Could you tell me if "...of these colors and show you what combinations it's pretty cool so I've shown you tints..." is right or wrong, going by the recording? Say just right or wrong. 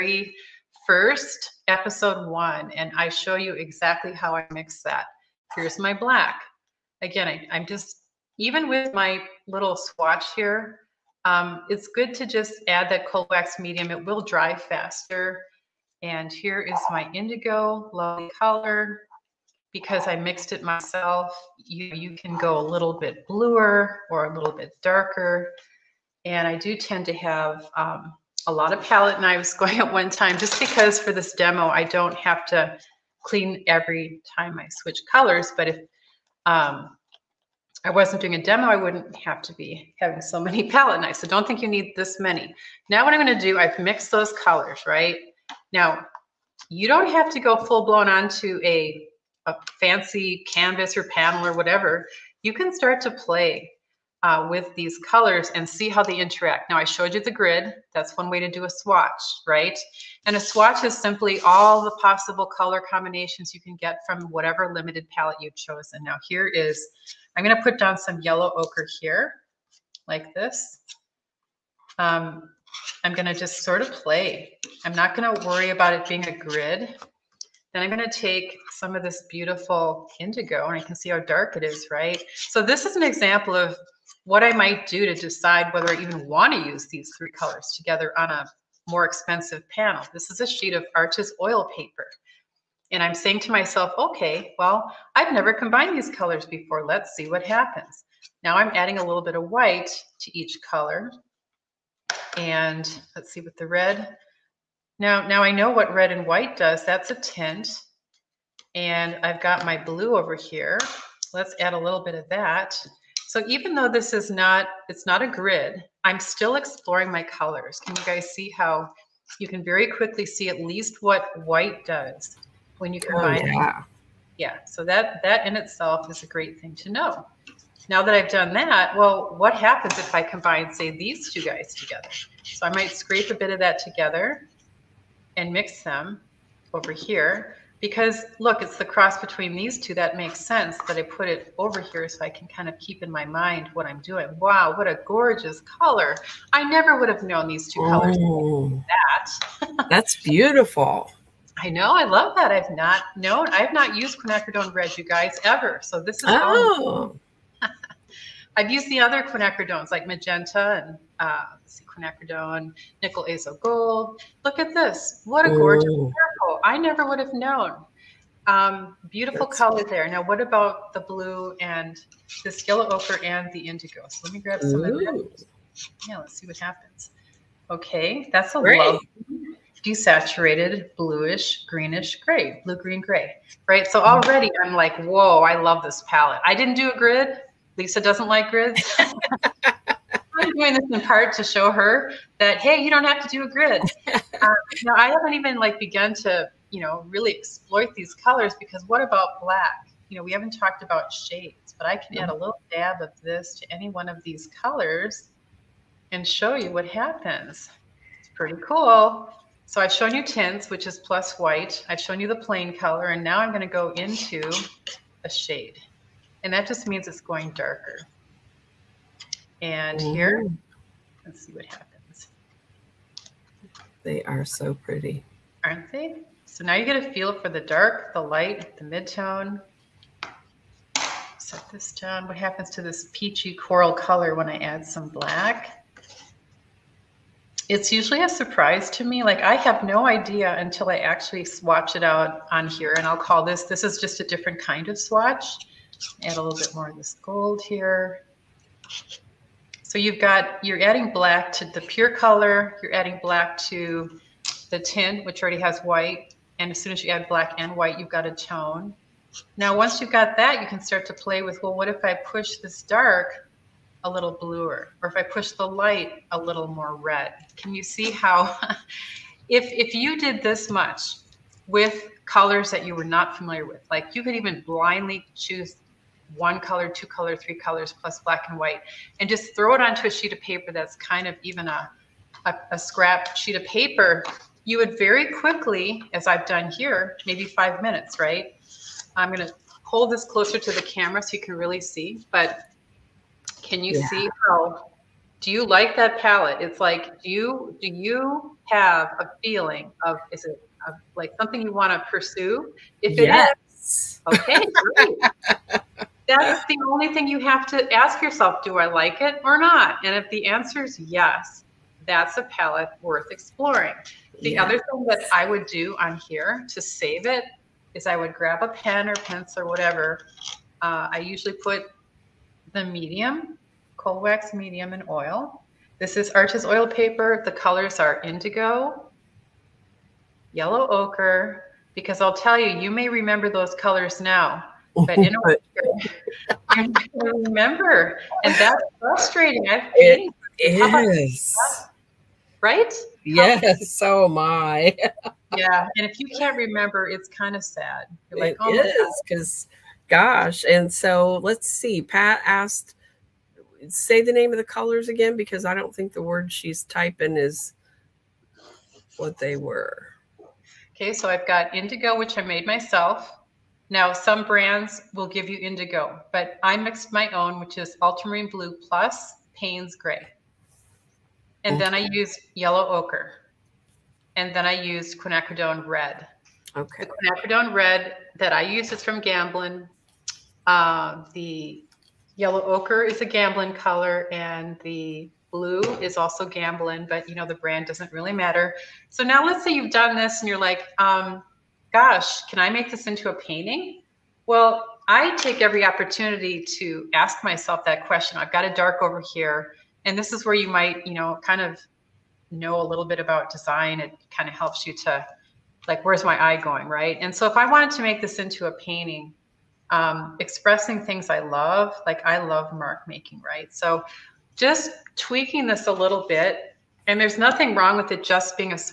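wrong.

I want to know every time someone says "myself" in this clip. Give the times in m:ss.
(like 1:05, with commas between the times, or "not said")
0:20, 1:33, 6:02, 6:37.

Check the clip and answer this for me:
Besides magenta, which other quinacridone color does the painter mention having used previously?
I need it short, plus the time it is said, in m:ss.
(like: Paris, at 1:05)
nickel azo gold, at 2:43.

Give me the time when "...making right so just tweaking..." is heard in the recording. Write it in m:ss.
6:53.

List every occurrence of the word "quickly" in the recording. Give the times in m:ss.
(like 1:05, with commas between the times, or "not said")
1:59, 4:45.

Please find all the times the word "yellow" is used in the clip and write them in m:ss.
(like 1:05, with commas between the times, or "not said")
1:08, 2:52, 5:30, 6:12, 6:22.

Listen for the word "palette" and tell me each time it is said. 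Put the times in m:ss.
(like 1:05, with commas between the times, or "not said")
0:28, 0:40, 1:05, 3:06, 4:56, 5:12.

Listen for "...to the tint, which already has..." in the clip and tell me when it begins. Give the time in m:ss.
4:13.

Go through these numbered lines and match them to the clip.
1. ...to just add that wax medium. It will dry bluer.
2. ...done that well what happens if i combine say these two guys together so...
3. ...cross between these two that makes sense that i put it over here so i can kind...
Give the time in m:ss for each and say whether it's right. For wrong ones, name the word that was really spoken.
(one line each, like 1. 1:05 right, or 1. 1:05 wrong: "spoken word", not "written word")
1. 0:12 wrong: "faster", not "bluer"
2. 2:08 right
3. 2:18 right.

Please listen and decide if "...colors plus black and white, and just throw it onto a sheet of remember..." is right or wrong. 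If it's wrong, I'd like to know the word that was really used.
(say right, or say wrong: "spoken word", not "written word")
wrong: "paper", not "remember".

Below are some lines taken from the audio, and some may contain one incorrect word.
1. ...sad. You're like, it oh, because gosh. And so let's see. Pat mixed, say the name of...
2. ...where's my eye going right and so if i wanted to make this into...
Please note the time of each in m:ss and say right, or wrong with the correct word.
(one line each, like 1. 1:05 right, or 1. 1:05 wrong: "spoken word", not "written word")
1. 5:47 wrong: "asked", not "mixed"
2. 6:46 right.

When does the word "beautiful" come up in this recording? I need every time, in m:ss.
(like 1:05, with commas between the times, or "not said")
1:19, 2:30, 2:49.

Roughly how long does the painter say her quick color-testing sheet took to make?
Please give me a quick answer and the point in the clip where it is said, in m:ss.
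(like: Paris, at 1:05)
5 minutes, at 4:47.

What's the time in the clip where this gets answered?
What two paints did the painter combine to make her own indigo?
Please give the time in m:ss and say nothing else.
6:08.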